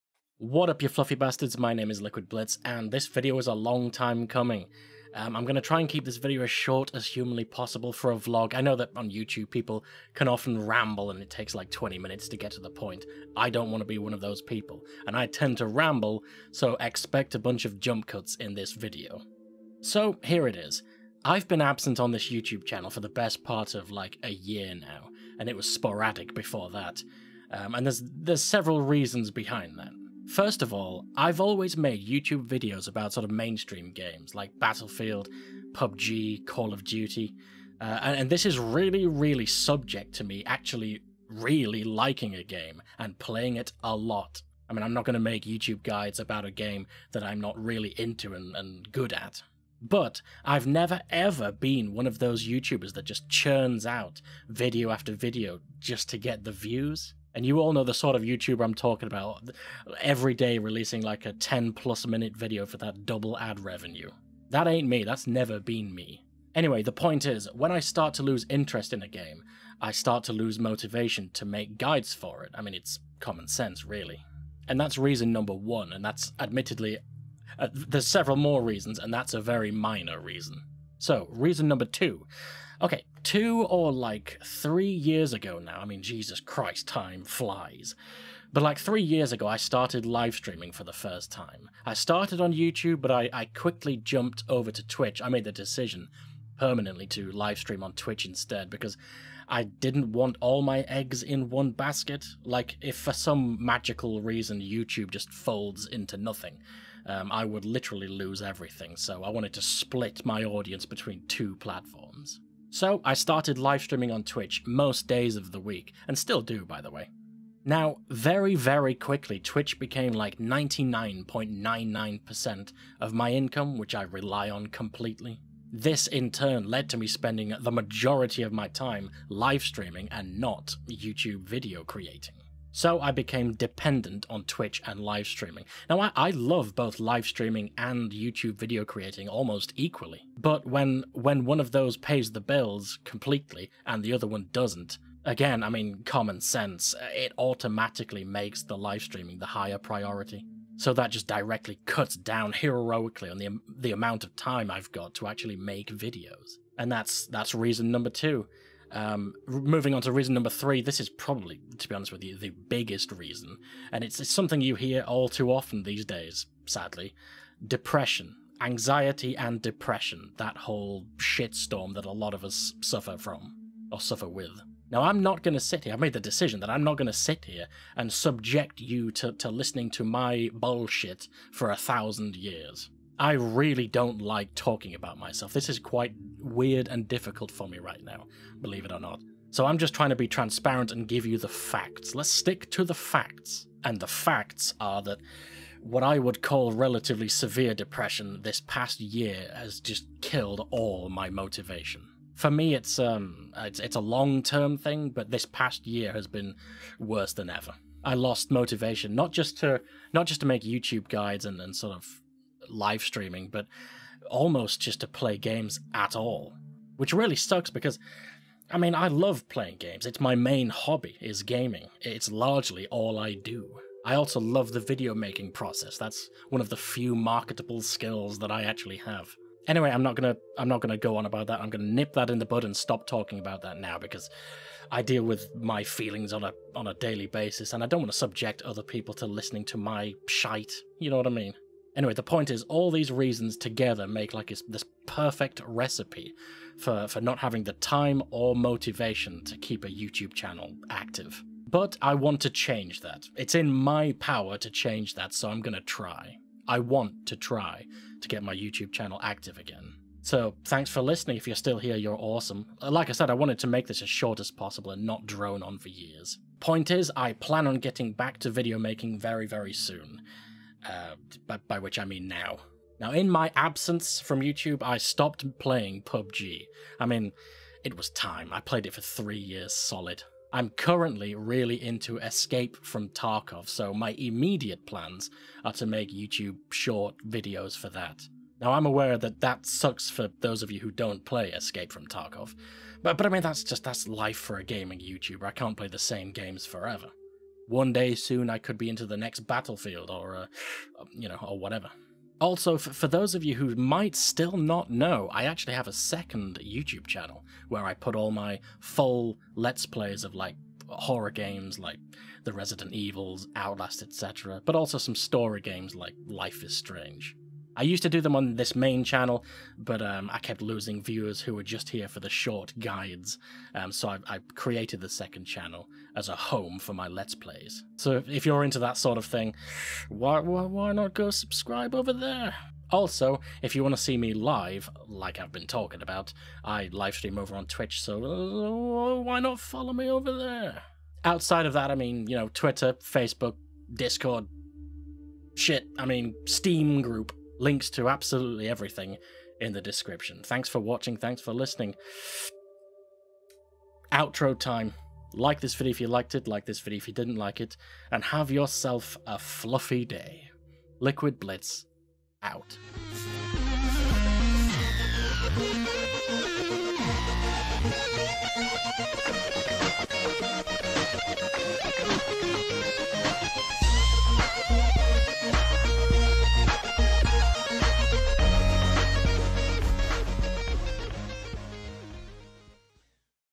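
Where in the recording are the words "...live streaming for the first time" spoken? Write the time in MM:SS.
01:30.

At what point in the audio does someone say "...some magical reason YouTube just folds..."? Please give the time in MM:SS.
01:43.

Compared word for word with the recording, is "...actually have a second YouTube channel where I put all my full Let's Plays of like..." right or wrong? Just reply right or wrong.
right.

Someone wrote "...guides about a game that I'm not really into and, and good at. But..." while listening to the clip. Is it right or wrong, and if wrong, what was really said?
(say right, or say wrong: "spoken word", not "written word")
right.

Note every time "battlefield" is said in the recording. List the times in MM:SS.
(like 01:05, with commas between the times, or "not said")
00:34, 04:59.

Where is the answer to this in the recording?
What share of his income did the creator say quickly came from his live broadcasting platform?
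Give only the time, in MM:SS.
02:00.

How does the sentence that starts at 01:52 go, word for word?
So I started live streaming on Twitch most days of the week, and still do, by the way.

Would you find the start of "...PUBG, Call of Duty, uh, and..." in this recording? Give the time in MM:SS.
00:35.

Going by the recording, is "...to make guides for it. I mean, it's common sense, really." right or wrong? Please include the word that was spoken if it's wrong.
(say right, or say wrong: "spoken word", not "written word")
right.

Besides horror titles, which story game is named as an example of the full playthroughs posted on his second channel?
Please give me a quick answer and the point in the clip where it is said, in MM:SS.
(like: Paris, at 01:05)
Life is Strange, at 05:16.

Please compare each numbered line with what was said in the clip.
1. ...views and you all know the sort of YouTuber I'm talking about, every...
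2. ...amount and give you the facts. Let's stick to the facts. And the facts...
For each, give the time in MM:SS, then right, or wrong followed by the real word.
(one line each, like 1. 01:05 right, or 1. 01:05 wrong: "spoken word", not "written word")
1. 00:56 right
2. 03:10 wrong: "transparent", not "amount".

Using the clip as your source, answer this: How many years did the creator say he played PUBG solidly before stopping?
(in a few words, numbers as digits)
3 years.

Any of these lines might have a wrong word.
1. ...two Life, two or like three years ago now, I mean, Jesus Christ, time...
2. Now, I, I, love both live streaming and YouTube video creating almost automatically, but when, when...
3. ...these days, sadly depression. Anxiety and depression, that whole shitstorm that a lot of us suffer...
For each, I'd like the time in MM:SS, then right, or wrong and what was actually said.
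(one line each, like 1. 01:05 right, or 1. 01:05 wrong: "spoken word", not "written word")
1. 01:21 wrong: "Okay", not "Life"
2. 02:15 wrong: "equally", not "automatically"
3. 02:45 right.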